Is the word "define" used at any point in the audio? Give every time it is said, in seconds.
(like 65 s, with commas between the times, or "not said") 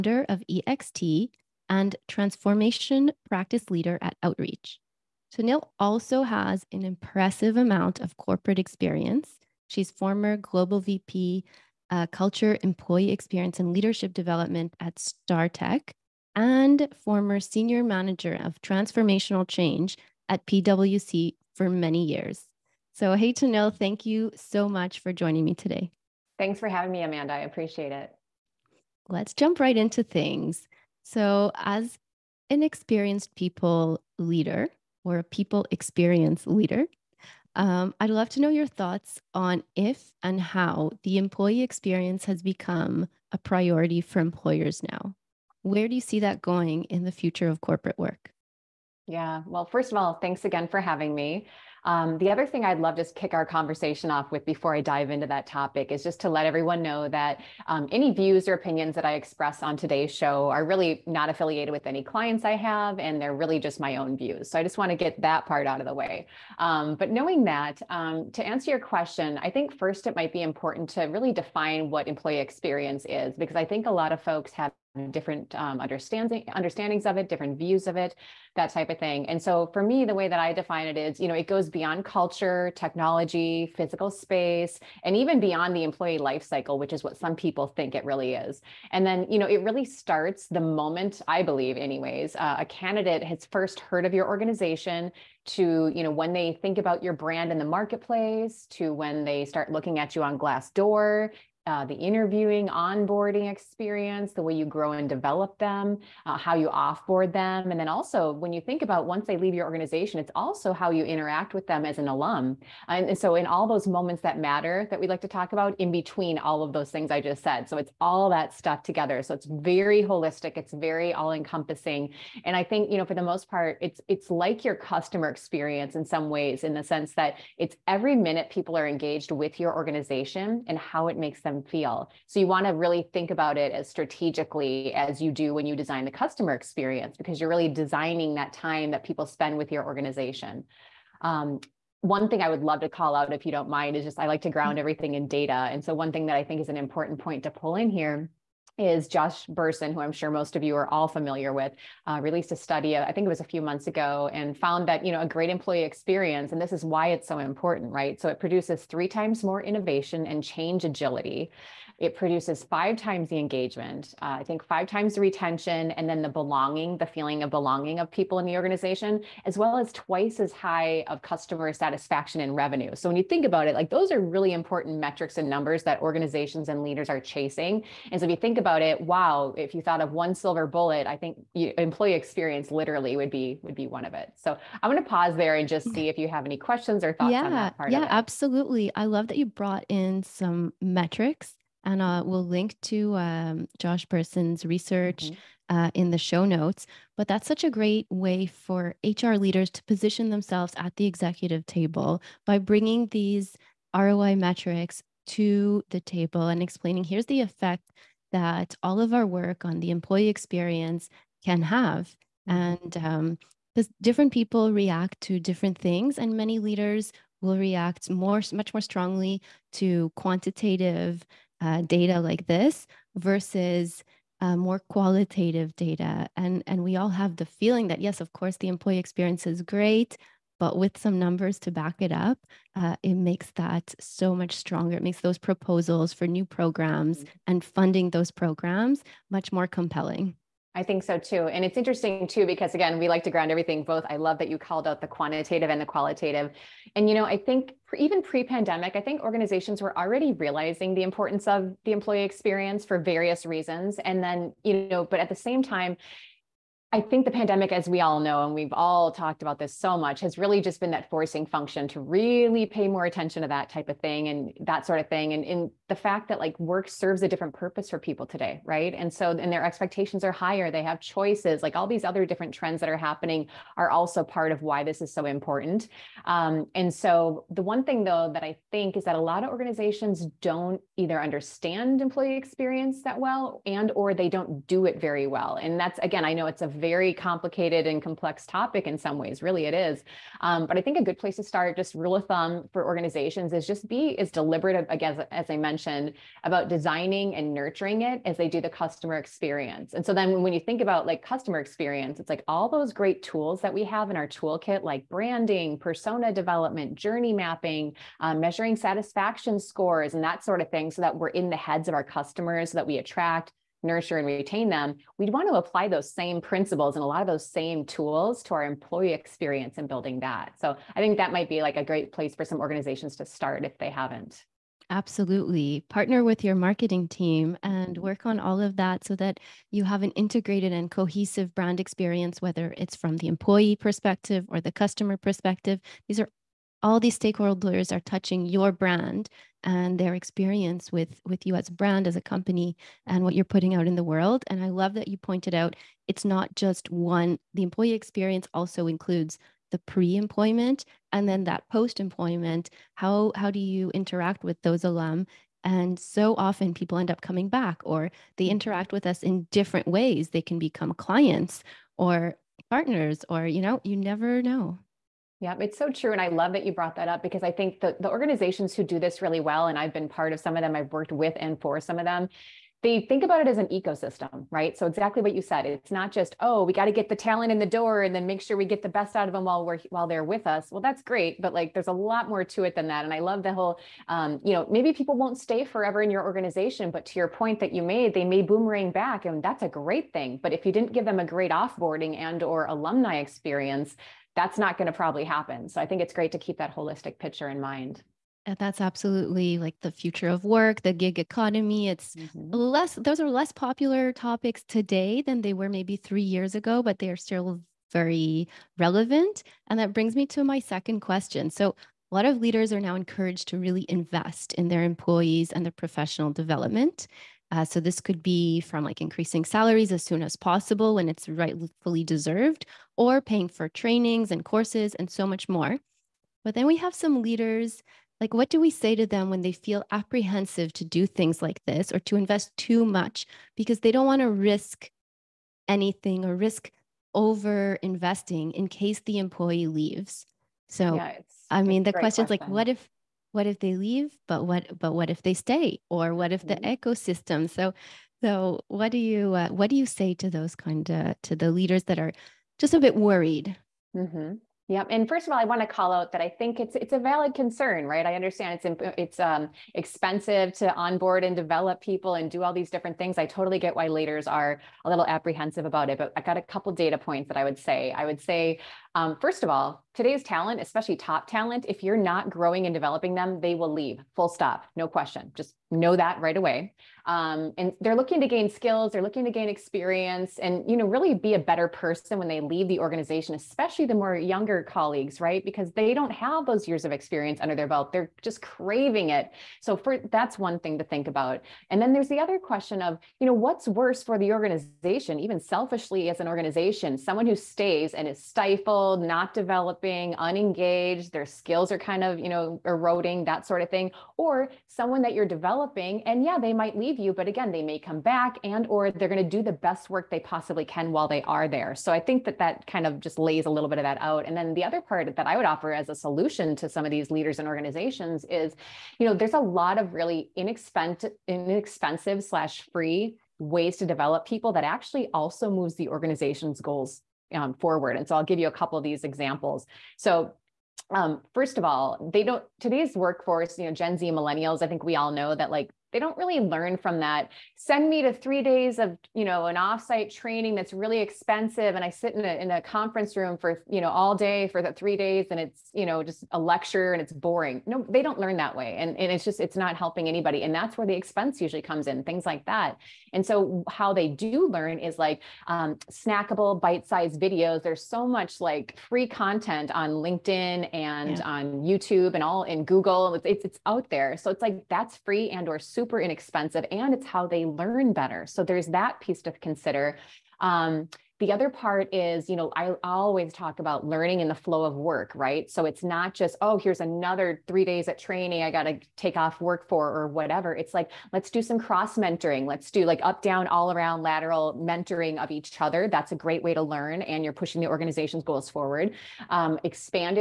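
71 s, 80 s.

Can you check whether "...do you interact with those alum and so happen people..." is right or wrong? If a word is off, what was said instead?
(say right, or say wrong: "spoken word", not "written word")
wrong: "often", not "happen".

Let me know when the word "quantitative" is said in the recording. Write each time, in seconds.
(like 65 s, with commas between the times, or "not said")
220 s, 245 s.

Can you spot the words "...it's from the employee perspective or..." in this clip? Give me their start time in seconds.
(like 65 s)
332 s.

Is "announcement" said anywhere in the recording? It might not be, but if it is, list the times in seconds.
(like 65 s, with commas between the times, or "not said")
not said.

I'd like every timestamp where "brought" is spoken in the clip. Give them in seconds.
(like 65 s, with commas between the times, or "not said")
189 s, 366 s.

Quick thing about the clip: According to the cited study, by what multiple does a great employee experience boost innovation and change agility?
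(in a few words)
3 times.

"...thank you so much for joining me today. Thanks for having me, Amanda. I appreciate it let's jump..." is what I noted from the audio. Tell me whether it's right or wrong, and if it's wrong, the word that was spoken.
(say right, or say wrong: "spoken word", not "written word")
right.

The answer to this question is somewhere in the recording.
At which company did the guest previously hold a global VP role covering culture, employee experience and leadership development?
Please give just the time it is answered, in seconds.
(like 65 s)
14 s.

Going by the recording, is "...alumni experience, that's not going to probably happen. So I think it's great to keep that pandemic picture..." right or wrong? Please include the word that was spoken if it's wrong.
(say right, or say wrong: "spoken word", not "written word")
wrong: "holistic", not "pandemic".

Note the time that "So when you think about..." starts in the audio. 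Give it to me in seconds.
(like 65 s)
172 s.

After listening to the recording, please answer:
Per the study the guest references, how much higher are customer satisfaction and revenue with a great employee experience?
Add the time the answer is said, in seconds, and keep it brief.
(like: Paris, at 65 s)
twice, at 169 s.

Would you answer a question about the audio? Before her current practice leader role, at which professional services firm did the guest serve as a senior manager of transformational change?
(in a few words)
PwC.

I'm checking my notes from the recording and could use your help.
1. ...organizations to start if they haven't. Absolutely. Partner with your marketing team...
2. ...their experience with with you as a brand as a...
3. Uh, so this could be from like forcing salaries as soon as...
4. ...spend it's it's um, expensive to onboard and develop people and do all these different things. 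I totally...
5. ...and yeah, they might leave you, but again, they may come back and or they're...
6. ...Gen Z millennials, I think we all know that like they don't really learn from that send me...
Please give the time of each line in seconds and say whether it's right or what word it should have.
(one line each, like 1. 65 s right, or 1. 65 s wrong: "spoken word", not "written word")
1. 322 s right
2. 339 s right
3. 417 s wrong: "increasing", not "forcing"
4. 458 s wrong: "understand", not "spend"
5. 506 s right
6. 533 s right.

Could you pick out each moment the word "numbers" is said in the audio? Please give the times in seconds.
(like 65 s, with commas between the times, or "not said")
175 s, 231 s.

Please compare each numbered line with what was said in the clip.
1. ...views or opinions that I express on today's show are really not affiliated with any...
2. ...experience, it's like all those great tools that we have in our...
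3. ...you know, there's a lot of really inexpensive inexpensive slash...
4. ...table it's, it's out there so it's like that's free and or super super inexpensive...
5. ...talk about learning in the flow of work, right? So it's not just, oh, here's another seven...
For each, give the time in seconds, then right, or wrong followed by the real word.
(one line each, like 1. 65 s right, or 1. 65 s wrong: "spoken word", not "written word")
1. 58 s right
2. 301 s right
3. 518 s right
4. 562 s wrong: "google", not "table"
5. 573 s wrong: "three", not "seven".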